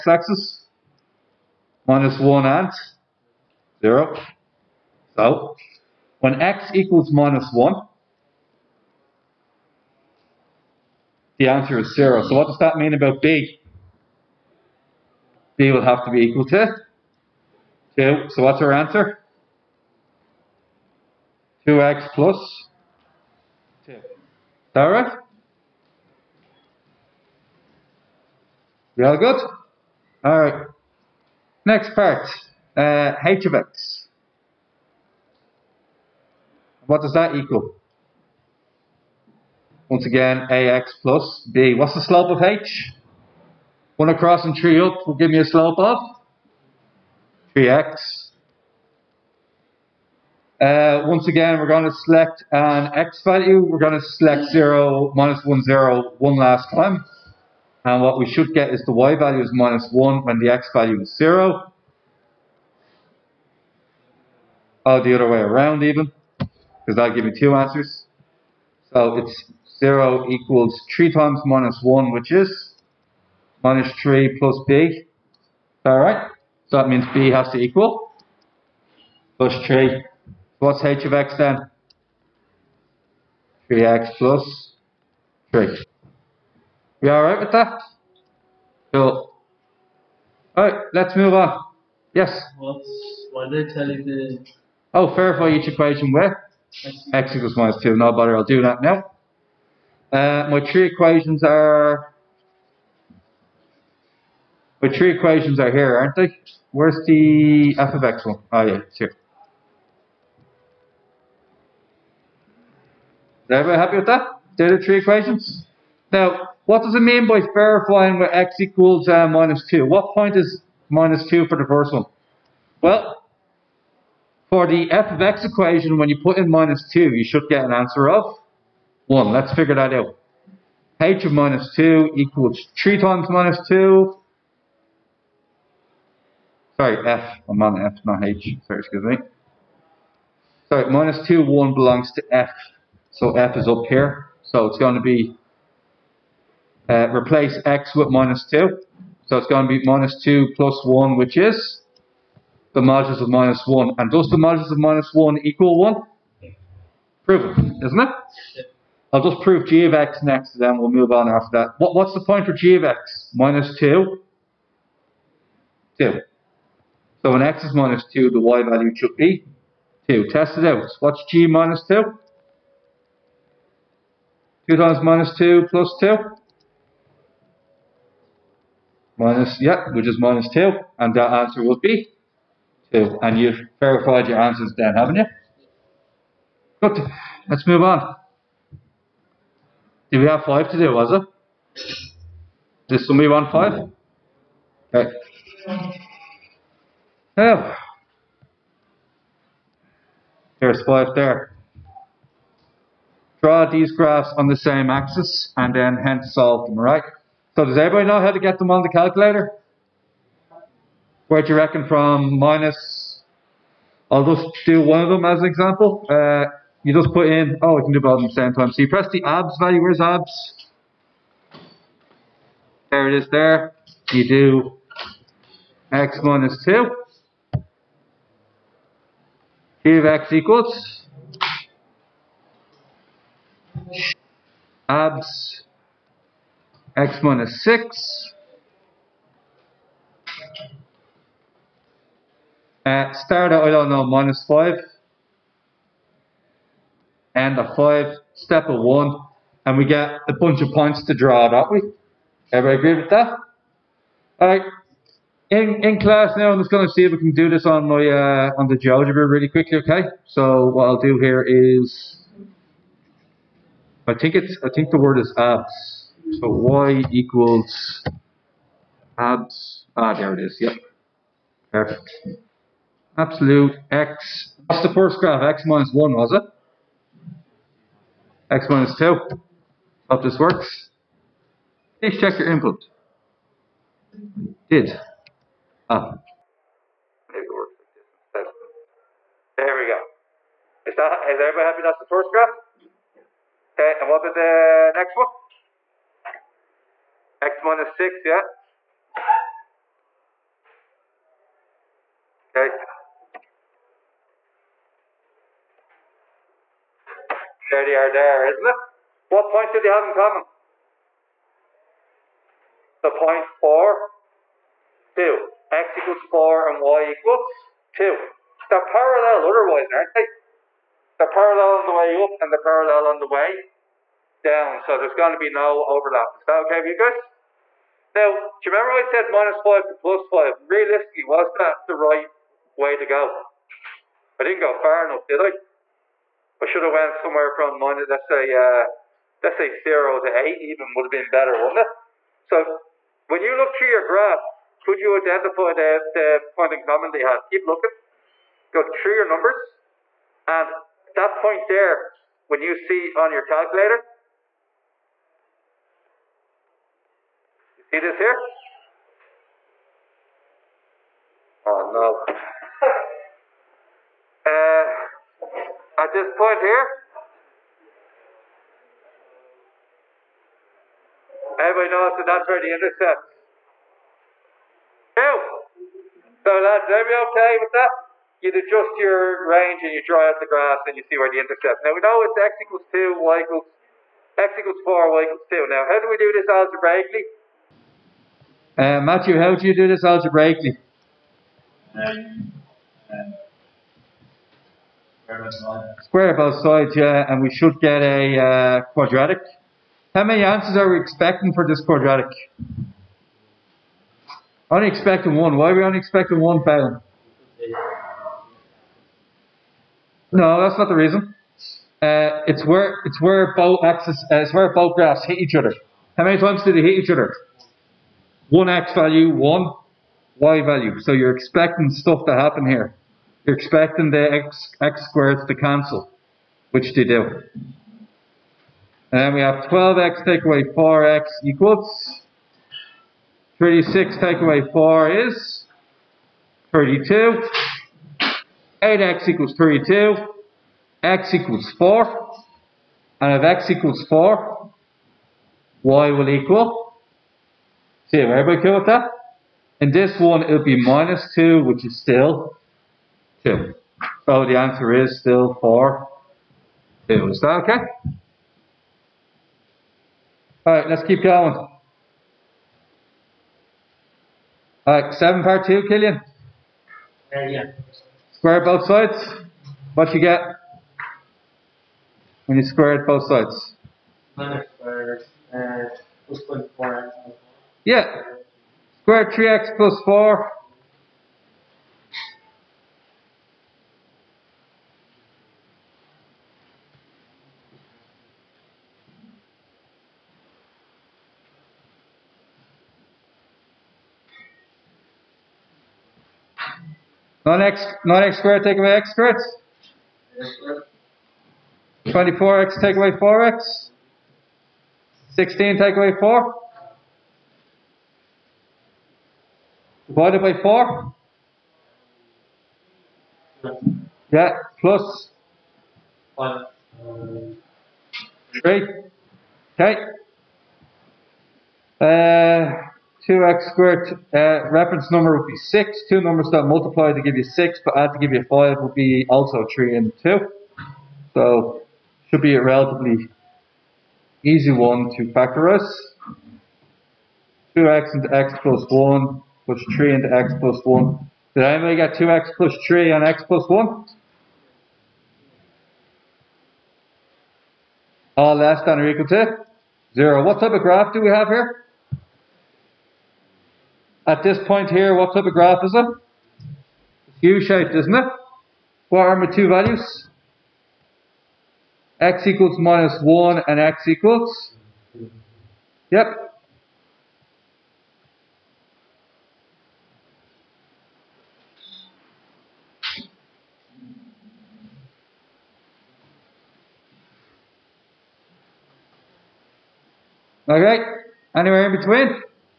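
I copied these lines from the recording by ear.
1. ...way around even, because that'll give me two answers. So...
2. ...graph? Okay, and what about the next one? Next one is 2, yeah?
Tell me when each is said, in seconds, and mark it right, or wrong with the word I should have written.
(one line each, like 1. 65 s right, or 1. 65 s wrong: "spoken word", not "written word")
1. 65 s right
2. 292 s wrong: "6", not "2".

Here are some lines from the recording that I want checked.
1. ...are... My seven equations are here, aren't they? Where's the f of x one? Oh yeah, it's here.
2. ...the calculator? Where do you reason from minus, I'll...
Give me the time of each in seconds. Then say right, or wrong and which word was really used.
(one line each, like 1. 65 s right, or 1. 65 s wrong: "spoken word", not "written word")
1. 101 s wrong: "three", not "seven"
2. 208 s wrong: "reckon", not "reason".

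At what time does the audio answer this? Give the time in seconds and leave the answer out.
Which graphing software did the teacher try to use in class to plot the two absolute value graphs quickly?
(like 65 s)
258 s.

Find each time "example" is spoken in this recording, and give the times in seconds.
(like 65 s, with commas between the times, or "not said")
215 s.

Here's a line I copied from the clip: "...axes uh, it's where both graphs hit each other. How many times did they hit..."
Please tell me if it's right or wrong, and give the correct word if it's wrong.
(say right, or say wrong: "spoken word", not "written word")
right.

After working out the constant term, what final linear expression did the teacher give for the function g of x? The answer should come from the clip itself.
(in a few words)
2x + 2.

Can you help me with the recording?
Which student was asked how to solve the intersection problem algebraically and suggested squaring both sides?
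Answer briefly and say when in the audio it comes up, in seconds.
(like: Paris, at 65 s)
Matthew, at 389 s.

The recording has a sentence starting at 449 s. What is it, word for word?
And this one, it'll be minus 2, which is still 2.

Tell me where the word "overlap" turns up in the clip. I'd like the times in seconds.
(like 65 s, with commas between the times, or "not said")
325 s.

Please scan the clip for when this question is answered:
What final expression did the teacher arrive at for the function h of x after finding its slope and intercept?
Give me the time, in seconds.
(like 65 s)
83 s.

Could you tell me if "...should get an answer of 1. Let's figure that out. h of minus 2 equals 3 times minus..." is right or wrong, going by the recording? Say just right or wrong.
right.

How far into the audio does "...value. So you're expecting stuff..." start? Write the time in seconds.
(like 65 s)
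420 s.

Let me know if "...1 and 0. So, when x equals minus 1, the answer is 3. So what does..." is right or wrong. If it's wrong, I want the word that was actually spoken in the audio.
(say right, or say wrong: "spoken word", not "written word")
wrong: "0", not "3".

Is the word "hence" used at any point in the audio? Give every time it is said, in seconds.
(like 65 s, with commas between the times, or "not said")
205 s.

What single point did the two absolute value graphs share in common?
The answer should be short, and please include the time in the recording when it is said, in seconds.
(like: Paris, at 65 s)
(4, 2), at 313 s.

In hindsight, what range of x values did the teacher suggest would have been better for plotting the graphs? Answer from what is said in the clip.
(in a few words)
0 to 8.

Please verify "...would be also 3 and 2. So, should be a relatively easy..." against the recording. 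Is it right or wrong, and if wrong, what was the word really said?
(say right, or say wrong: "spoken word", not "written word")
right.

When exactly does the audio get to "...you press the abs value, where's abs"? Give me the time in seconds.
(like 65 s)
218 s.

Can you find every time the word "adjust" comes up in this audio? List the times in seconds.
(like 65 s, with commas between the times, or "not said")
378 s.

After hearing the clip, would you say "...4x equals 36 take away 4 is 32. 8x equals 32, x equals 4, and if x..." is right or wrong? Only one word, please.
right.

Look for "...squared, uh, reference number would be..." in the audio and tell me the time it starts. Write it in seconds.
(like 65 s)
523 s.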